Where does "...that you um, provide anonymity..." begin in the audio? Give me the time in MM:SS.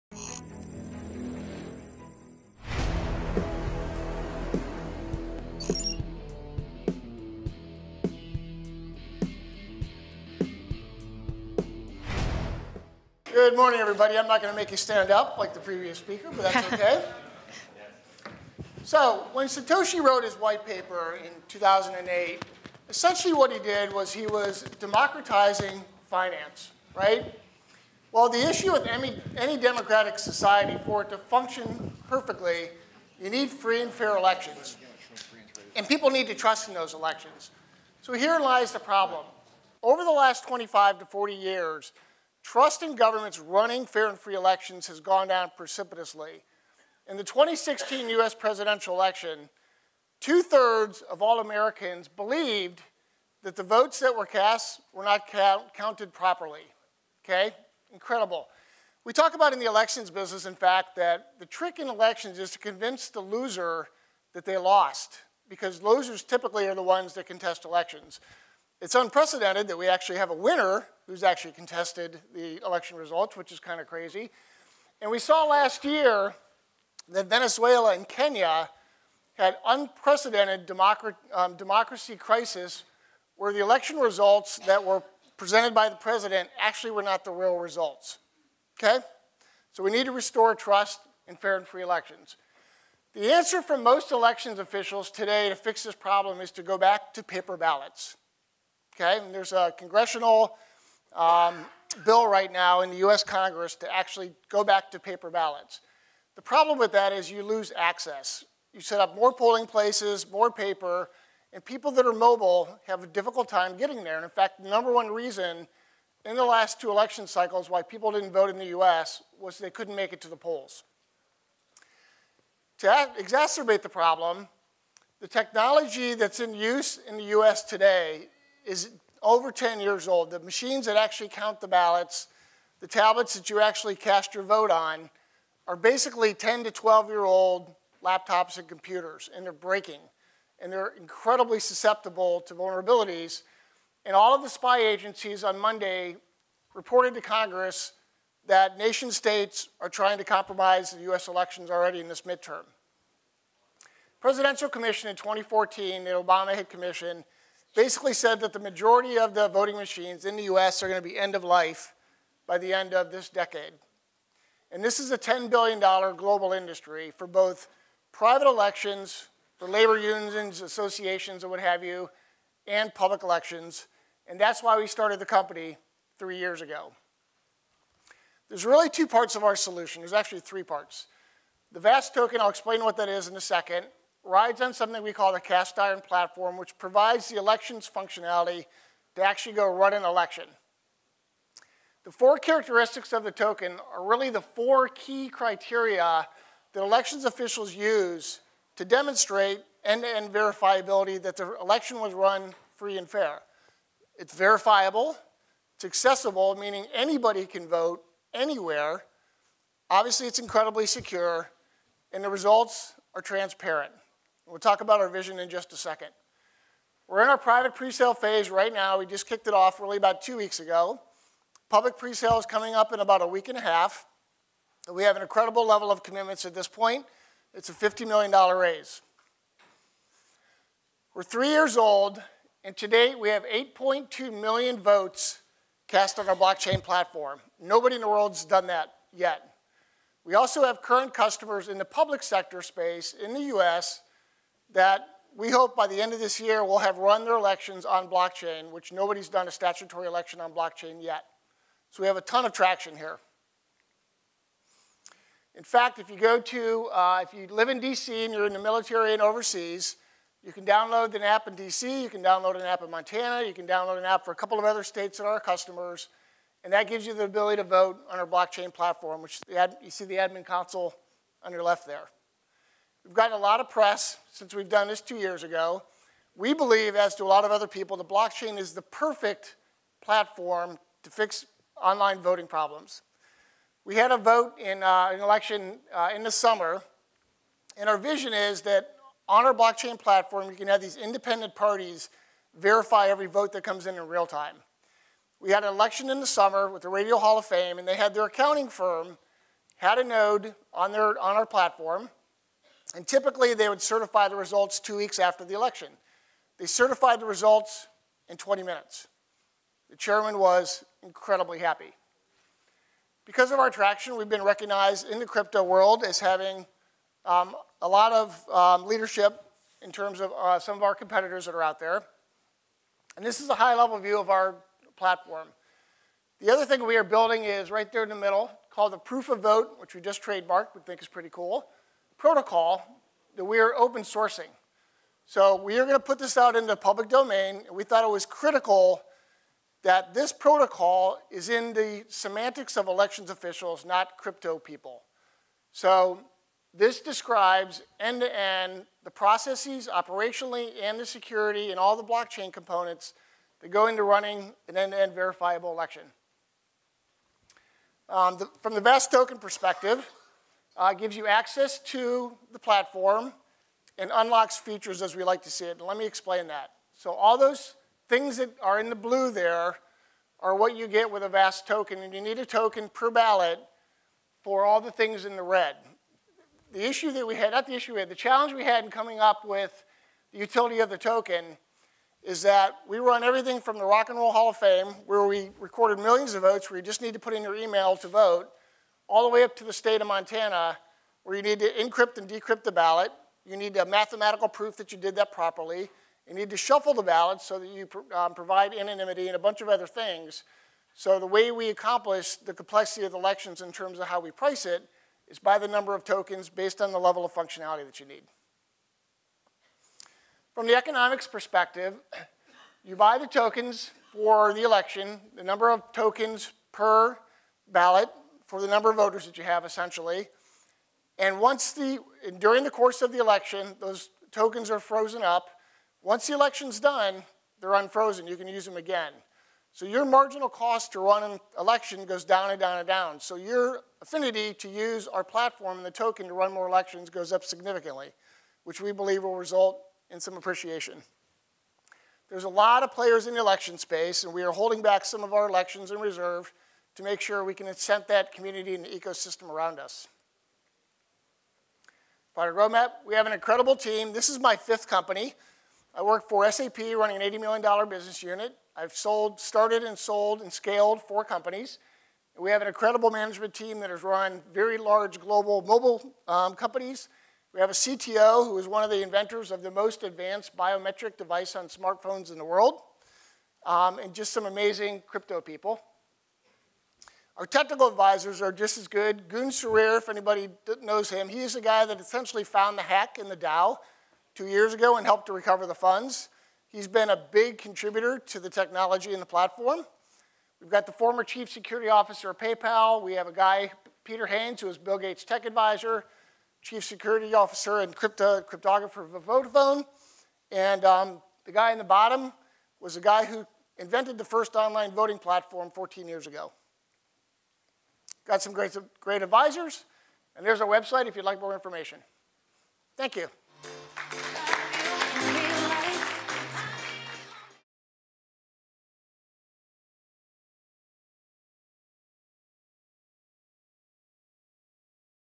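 06:37.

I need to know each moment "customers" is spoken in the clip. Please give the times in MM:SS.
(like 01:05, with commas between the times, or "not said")
04:01, 04:25.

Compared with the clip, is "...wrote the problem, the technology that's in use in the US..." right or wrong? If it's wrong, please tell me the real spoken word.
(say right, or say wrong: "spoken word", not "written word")
wrong: "exacerbate", not "wrote".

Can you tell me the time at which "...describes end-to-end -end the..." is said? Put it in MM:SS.
05:47.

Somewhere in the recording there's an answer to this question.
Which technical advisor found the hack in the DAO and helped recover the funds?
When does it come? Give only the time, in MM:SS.
07:59.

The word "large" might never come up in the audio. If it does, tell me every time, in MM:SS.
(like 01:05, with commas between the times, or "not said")
07:44.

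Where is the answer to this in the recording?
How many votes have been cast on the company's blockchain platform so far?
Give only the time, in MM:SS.
03:53.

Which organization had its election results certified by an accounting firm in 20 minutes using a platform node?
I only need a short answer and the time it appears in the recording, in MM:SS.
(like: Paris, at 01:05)
Radio Hall of Fame, at 04:56.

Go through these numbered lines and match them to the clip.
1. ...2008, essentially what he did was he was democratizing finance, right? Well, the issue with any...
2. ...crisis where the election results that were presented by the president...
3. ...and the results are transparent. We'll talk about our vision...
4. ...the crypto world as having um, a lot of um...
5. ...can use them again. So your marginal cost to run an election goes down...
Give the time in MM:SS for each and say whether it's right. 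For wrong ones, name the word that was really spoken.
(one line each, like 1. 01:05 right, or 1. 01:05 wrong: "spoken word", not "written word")
1. 00:21 right
2. 01:22 right
3. 03:32 right
4. 05:15 right
5. 07:08 right.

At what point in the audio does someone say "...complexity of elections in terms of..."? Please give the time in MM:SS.
06:42.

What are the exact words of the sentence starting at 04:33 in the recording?
We've gotten a lot of press since we've done this two years ago.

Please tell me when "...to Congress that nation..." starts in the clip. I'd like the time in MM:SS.
02:27.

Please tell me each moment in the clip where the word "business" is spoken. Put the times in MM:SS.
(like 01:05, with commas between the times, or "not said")
01:00, 07:37.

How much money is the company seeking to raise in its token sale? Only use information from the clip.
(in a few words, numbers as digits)
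$50 million.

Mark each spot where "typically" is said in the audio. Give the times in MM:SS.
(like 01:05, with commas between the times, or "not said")
01:06, 05:03.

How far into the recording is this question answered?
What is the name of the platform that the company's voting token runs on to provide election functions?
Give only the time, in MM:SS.
03:05.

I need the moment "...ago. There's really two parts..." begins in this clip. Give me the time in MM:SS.
02:56.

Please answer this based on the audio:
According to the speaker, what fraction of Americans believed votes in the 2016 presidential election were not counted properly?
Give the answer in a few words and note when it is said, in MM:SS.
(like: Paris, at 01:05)
two thirds, at 00:50.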